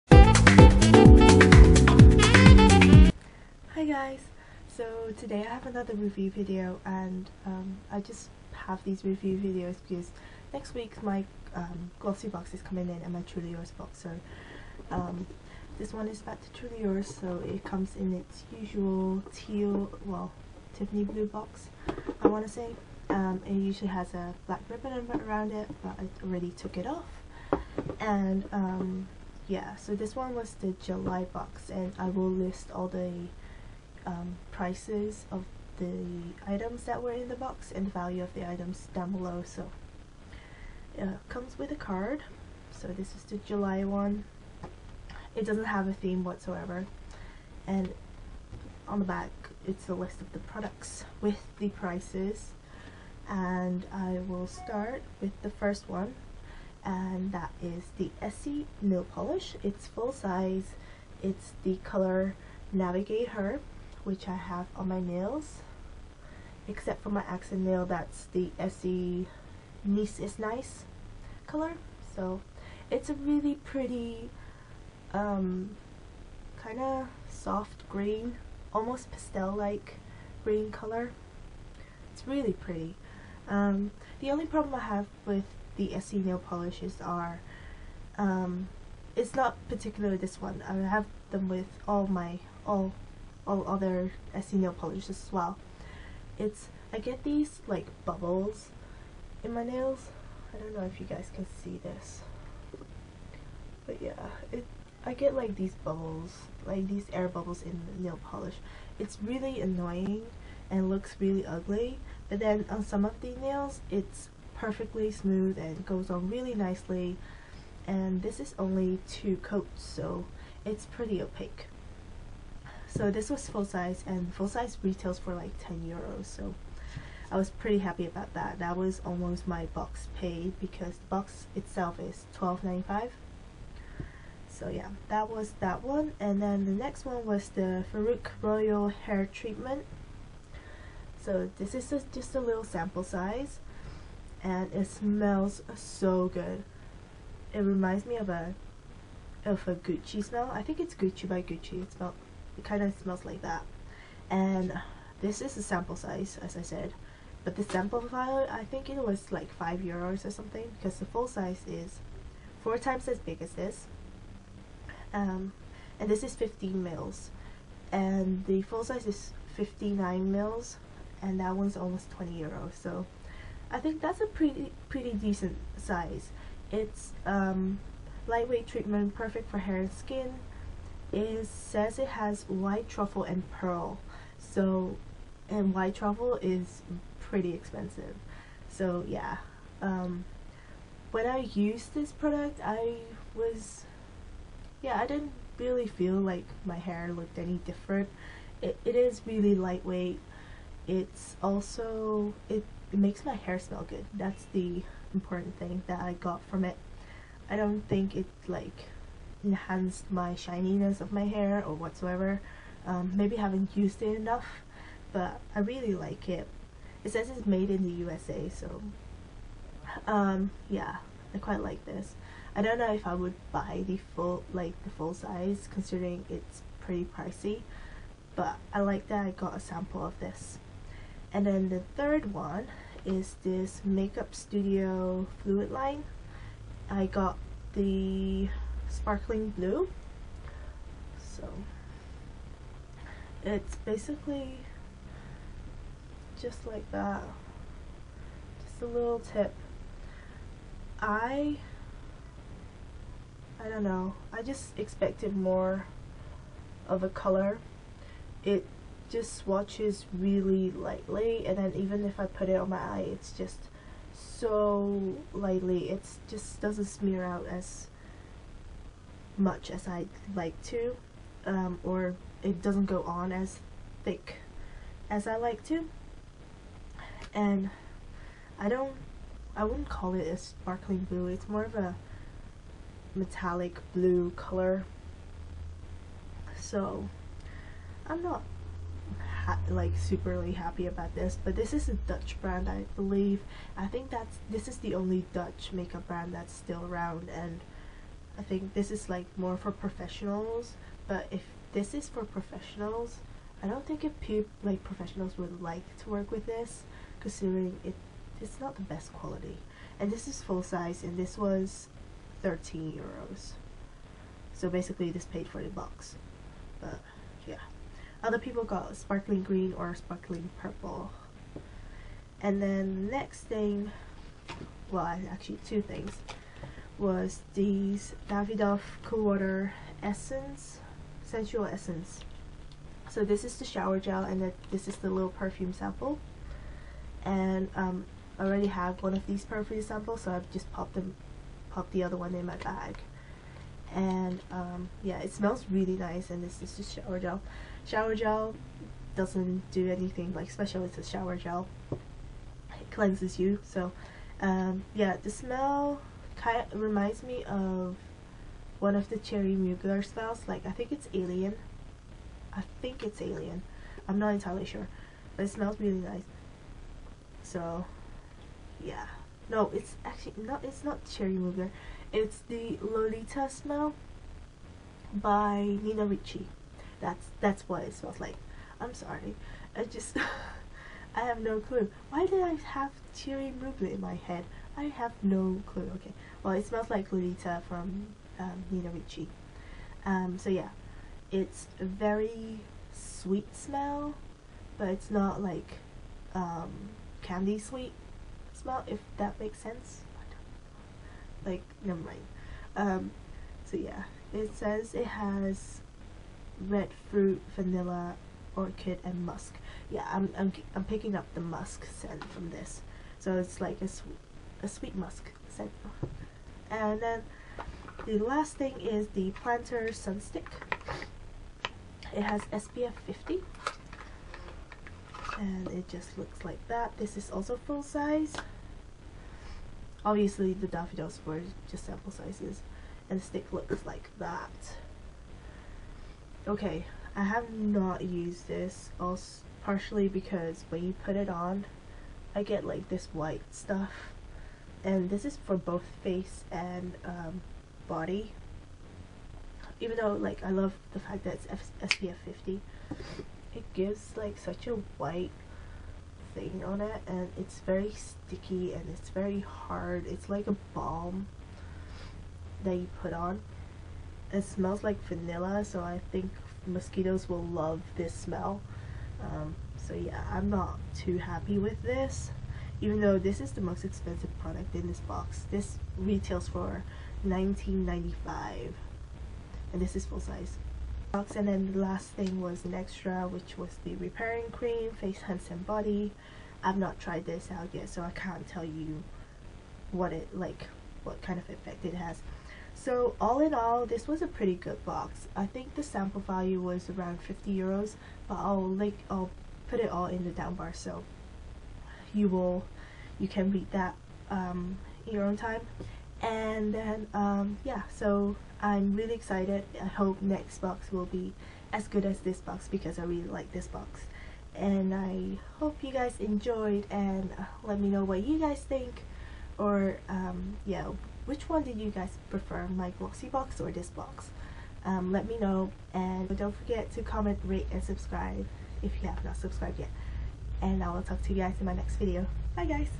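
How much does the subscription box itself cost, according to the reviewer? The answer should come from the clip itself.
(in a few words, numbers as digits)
12.95.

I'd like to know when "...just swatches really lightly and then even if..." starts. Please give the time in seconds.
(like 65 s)
259 s.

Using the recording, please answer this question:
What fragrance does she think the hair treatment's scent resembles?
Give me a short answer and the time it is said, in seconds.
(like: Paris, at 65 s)
Gucci by Gucci, at 150 s.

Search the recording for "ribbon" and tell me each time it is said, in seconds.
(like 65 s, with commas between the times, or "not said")
24 s.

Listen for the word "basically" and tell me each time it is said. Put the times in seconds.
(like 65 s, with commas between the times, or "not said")
243 s, 314 s.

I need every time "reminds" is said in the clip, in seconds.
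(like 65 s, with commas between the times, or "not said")
147 s, 356 s.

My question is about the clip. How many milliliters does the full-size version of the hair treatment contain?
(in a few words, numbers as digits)
59.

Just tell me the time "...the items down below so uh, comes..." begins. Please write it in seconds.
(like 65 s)
38 s.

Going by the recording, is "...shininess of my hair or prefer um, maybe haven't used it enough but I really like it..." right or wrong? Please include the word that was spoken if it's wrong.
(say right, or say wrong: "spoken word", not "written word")
wrong: "whatsoever", not "prefer".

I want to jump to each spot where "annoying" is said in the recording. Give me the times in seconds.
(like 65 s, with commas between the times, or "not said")
109 s.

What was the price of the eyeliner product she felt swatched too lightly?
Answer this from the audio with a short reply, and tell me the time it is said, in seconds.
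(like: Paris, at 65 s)
13 euros, at 312 s.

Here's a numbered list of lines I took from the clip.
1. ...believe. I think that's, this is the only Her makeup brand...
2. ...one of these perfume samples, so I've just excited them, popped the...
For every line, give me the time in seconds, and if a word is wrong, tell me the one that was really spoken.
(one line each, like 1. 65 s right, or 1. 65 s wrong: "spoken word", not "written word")
1. 292 s wrong: "Dutch", not "Her"
2. 339 s wrong: "popped", not "excited".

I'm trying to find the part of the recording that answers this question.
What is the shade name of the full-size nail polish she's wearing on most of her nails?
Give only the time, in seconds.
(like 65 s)
62 s.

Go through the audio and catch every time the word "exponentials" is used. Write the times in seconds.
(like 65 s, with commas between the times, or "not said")
not said.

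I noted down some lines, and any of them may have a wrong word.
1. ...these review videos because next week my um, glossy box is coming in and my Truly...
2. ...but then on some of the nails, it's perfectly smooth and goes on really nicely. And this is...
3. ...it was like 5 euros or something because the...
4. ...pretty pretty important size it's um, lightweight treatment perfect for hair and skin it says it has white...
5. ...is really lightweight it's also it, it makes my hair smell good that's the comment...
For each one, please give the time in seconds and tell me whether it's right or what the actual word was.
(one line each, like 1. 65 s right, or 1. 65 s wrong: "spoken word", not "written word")
1. 8 s right
2. 112 s right
3. 158 s right
4. 174 s wrong: "decent", not "important"
5. 198 s wrong: "important", not "comment".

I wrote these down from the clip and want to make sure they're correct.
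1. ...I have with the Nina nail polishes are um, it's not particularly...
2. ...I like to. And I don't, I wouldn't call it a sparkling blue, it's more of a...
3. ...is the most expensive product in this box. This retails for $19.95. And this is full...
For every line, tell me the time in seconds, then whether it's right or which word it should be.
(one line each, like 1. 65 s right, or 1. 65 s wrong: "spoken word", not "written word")
1. 84 s wrong: "Essie", not "Nina"
2. 275 s right
3. 473 s right.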